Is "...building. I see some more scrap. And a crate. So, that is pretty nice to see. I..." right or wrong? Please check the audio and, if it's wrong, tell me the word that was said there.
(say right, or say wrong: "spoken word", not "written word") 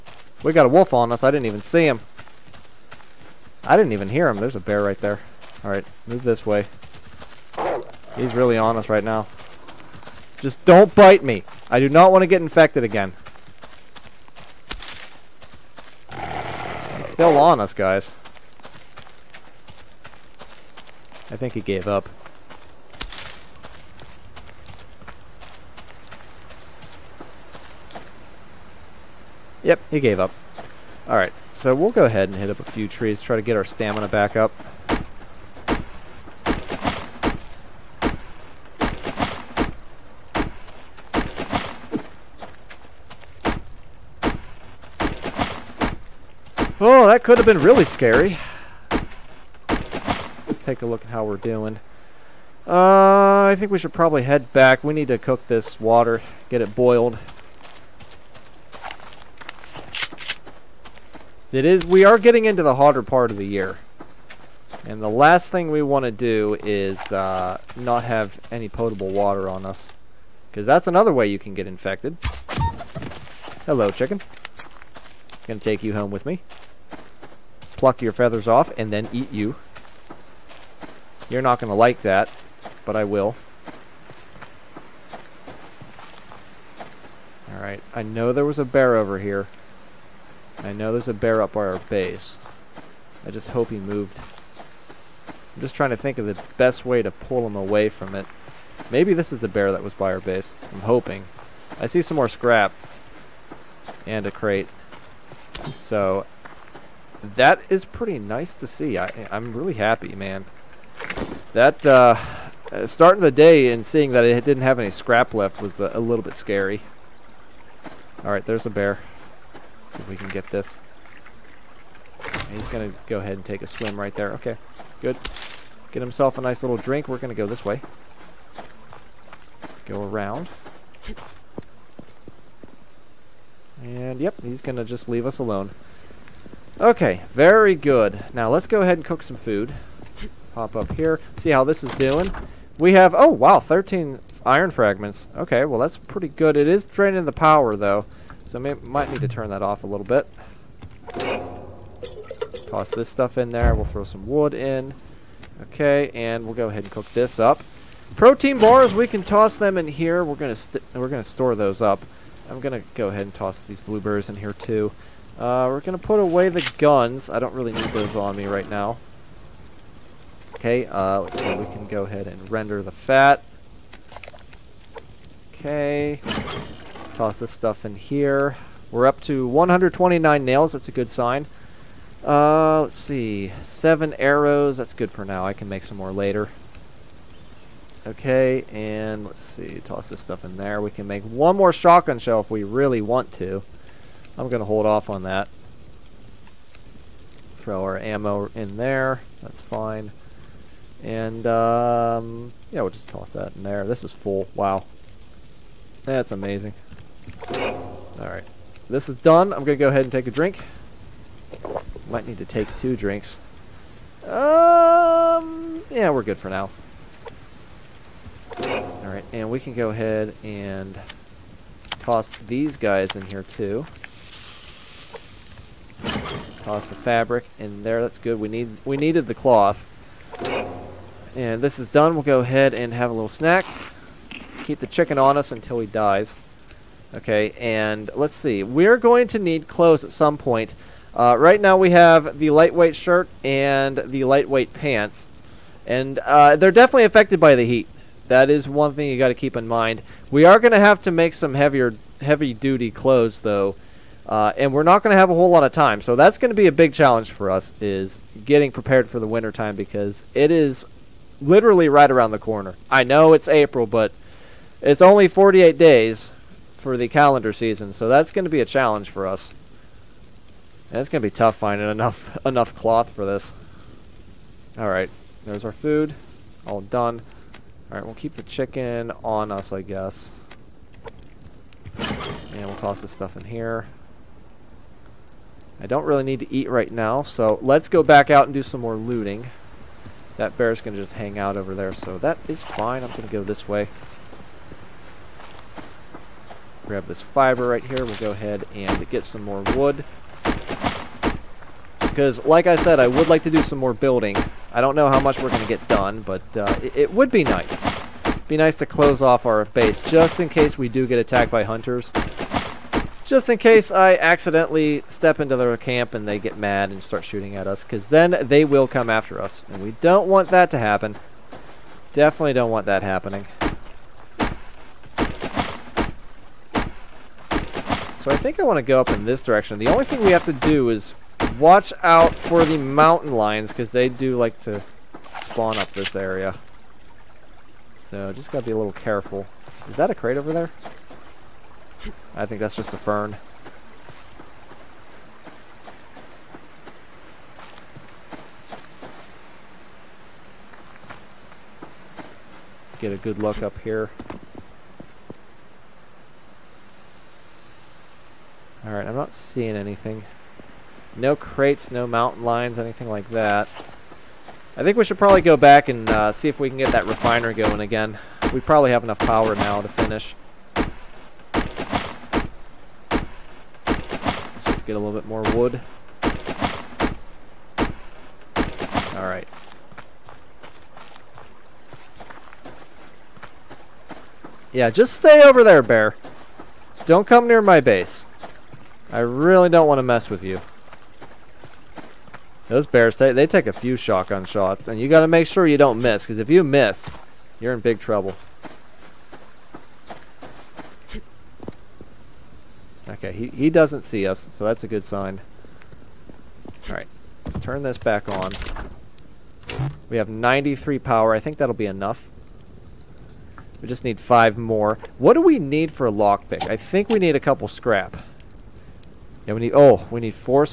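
wrong: "hoping", not "building".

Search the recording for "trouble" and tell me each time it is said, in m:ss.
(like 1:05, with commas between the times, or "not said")
6:38.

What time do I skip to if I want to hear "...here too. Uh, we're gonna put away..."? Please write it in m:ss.
2:44.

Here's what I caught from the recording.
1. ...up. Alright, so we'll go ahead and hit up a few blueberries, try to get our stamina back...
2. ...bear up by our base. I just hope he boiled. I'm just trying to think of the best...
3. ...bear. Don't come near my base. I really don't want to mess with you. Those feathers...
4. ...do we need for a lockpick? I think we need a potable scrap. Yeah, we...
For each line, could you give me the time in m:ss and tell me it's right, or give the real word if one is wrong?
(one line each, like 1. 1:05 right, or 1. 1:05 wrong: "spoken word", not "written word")
1. 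0:30 wrong: "trees", not "blueberries"
2. 1:31 wrong: "moved", not "boiled"
3. 6:25 wrong: "bears", not "feathers"
4. 6:55 wrong: "couple", not "potable".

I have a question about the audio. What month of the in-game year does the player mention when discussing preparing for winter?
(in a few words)
April.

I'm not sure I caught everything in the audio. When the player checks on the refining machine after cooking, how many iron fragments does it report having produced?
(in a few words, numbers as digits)
13.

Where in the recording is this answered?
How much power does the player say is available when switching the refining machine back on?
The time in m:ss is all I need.
6:50.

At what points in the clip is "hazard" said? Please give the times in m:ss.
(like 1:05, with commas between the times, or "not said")
not said.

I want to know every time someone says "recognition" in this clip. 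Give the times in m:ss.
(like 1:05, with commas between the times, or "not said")
not said.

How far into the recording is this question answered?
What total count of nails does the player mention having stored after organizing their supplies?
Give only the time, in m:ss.
2:59.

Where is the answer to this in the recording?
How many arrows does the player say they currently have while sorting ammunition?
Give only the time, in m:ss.
3:03.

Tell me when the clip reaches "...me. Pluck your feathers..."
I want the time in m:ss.
1:16.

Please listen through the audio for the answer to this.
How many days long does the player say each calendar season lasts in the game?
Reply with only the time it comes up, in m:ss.
4:25.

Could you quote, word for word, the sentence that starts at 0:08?
He's really on us right now.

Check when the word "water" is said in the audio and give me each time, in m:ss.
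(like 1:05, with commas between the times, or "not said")
0:55, 1:09.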